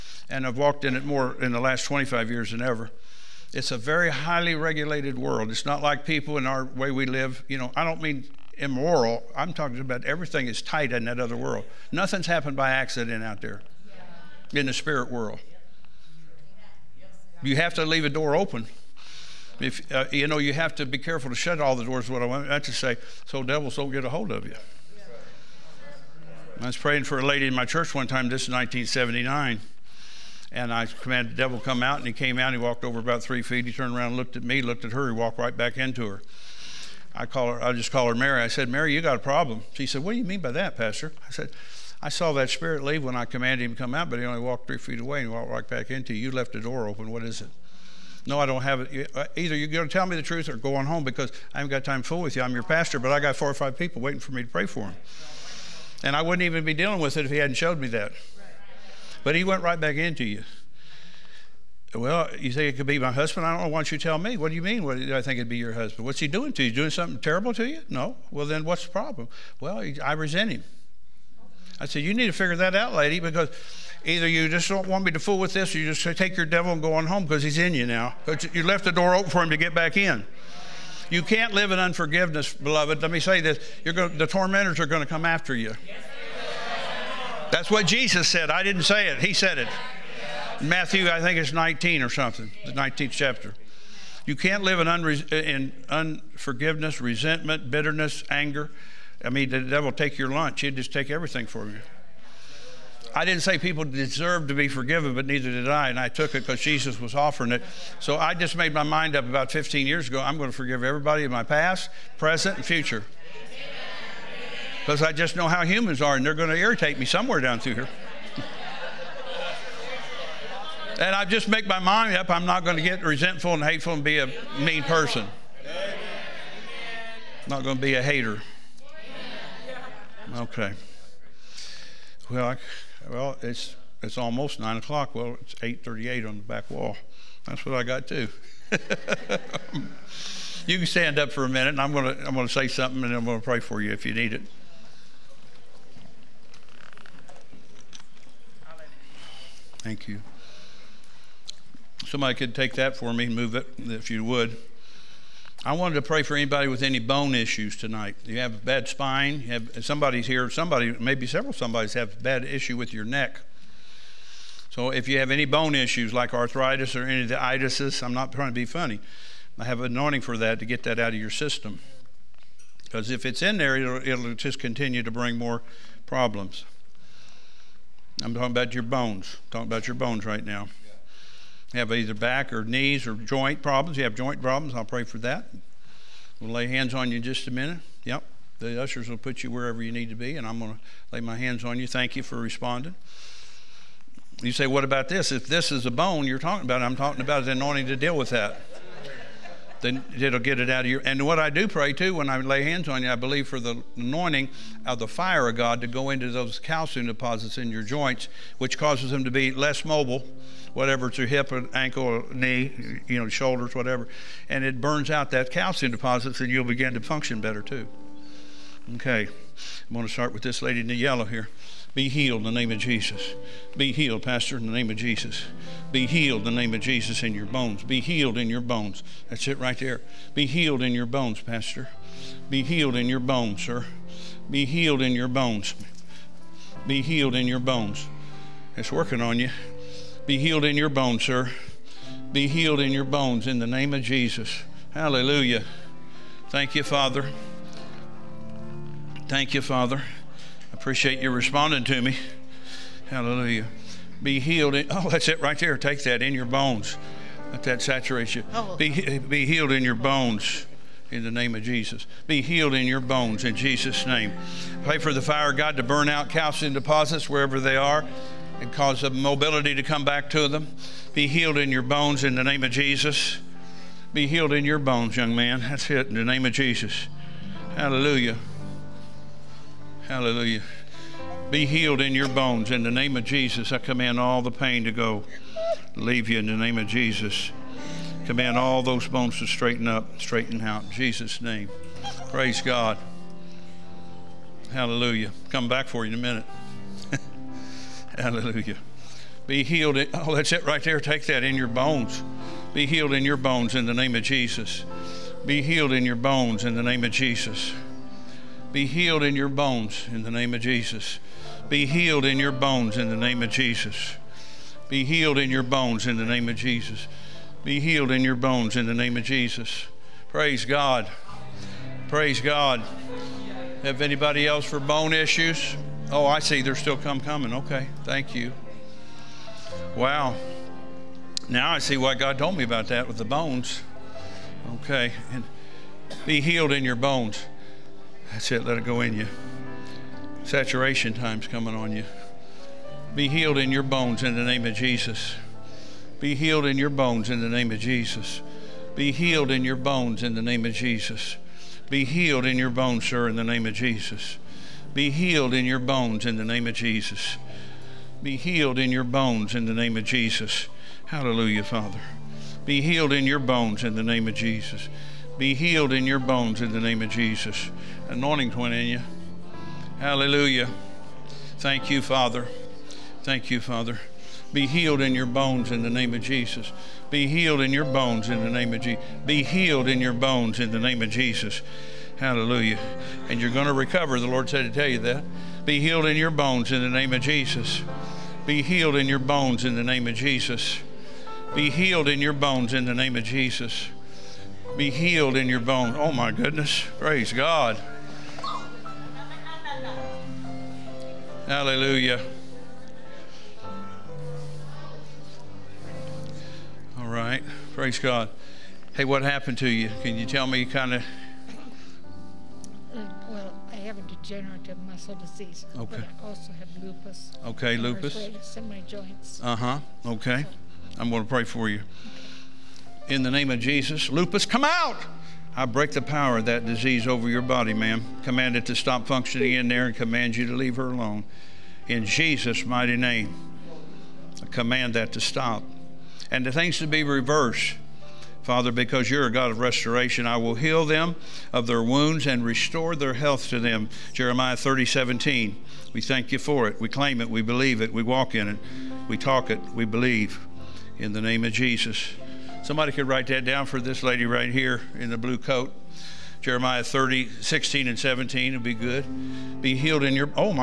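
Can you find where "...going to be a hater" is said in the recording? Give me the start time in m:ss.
2:07.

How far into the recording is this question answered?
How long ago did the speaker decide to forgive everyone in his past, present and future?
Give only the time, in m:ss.
1:49.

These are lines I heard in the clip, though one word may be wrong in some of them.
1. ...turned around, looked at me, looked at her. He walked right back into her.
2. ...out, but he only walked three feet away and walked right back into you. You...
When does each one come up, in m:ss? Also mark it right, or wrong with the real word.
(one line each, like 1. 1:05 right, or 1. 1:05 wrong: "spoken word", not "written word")
1. 0:33 right
2. 0:43 right.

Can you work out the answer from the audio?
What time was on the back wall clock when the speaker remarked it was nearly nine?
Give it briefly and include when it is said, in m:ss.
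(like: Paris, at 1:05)
8:38, at 2:15.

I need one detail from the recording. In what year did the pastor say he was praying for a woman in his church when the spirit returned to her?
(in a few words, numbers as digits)
1979.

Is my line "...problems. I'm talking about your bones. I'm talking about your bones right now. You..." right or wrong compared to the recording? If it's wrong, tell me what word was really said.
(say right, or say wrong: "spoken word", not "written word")
right.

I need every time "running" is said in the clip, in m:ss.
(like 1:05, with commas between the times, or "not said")
not said.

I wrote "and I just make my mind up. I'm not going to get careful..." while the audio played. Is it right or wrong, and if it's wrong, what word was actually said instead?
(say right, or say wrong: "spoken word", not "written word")
wrong: "resentful", not "careful".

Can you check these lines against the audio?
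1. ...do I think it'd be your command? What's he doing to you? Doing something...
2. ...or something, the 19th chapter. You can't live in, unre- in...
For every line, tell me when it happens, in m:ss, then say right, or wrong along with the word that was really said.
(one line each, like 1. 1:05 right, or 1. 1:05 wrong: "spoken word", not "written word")
1. 1:04 wrong: "husband", not "command"
2. 1:32 right.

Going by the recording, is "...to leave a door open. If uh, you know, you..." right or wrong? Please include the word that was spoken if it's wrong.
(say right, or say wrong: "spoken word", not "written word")
right.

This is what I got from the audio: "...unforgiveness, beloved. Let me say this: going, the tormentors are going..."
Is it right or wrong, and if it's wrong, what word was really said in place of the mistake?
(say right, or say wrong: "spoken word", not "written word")
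right.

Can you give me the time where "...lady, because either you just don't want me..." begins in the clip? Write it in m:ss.
1:12.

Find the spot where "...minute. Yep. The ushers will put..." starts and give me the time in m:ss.
3:07.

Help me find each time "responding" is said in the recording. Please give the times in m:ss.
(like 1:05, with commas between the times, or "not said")
3:12, 4:11.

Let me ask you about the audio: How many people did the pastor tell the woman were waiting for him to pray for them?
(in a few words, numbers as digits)
4 or 5.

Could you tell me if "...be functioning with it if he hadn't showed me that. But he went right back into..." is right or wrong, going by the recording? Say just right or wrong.
wrong.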